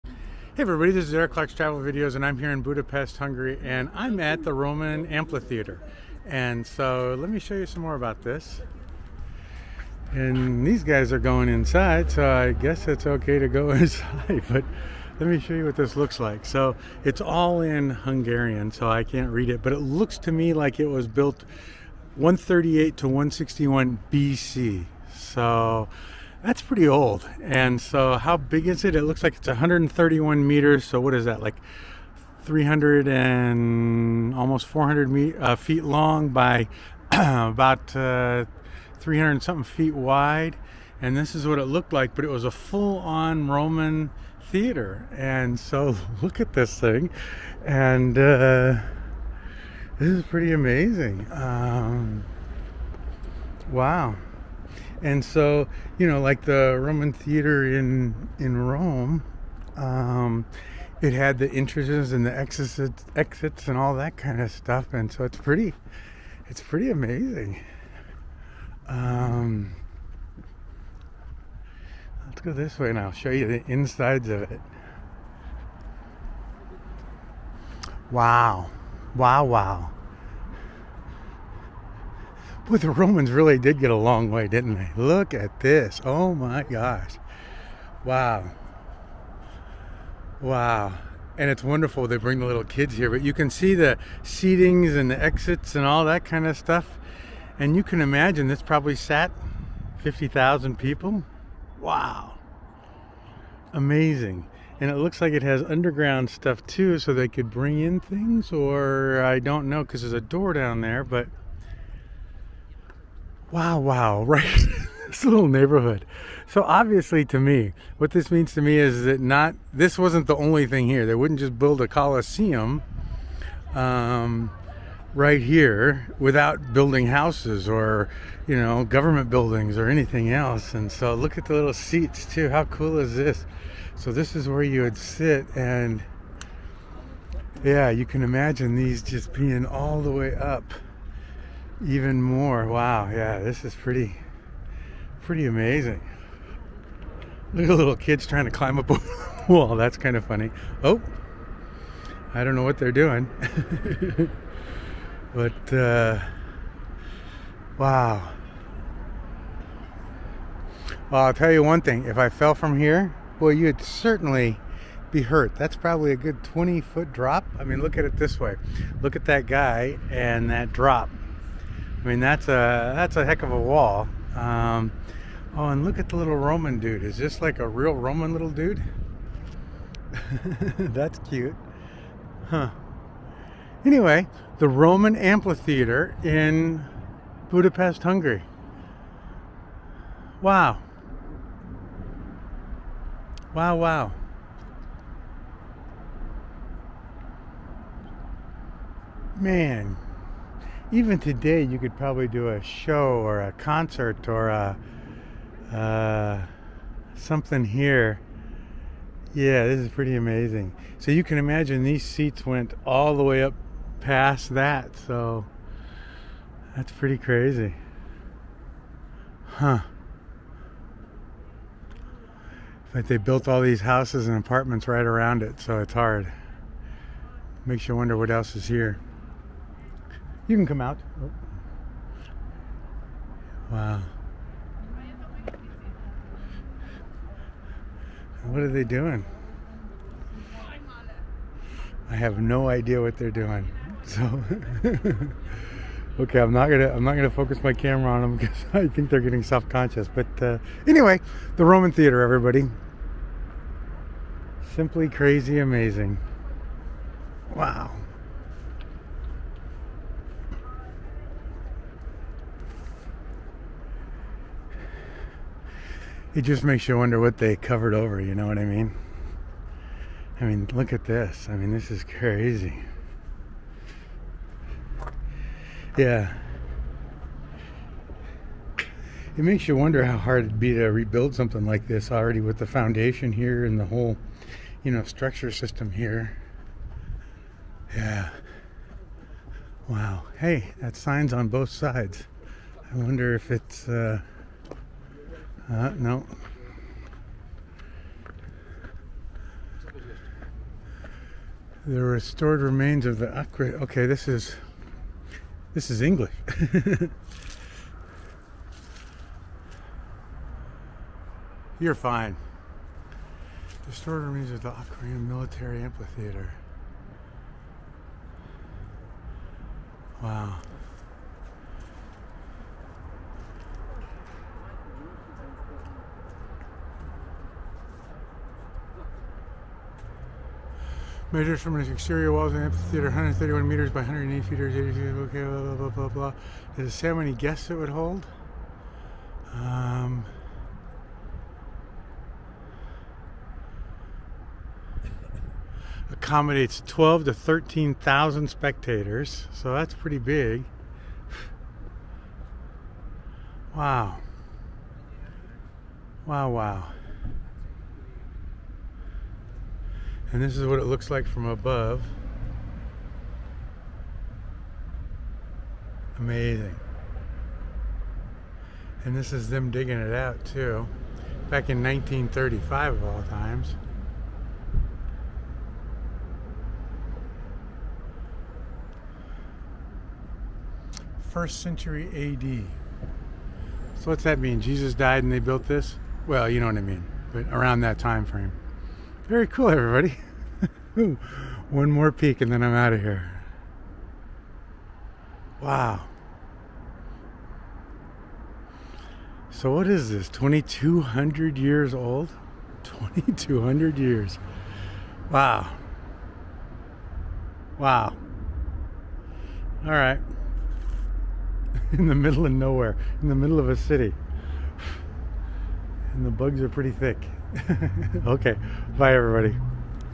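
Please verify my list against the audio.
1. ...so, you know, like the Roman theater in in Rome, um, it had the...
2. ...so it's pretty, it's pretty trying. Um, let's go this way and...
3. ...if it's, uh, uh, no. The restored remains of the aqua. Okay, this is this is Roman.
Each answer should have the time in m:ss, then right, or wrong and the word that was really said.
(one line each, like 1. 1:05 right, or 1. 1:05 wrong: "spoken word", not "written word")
1. 0:55 right
2. 1:05 wrong: "amazing", not "trying"
3. 4:53 wrong: "English", not "Roman".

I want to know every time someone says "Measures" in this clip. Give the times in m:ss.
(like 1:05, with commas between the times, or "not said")
5:31.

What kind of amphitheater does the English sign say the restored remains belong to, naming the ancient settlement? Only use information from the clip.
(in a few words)
Aquincum Military Amphitheater.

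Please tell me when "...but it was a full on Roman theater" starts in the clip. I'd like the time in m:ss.
0:42.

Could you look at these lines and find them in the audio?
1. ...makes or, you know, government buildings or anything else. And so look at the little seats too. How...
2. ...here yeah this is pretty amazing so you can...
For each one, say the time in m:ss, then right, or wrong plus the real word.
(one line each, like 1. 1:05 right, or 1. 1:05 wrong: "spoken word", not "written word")
1. 2:07 wrong: "houses", not "makes"
2. 3:27 right.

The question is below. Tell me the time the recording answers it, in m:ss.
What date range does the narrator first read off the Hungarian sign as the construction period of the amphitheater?
0:22.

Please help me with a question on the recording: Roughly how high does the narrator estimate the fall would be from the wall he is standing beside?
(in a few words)
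20 feet.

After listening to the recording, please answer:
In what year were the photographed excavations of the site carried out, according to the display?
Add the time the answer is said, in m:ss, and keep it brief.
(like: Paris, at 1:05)
1935, at 6:11.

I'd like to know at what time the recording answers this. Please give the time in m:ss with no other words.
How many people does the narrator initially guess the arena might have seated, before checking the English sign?
1:39.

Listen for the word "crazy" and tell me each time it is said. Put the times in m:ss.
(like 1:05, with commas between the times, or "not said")
3:37, 4:15, 4:32.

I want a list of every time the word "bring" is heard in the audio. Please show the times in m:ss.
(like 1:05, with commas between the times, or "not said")
1:32, 1:47.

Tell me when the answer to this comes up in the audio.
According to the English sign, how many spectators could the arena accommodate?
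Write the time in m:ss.
5:46.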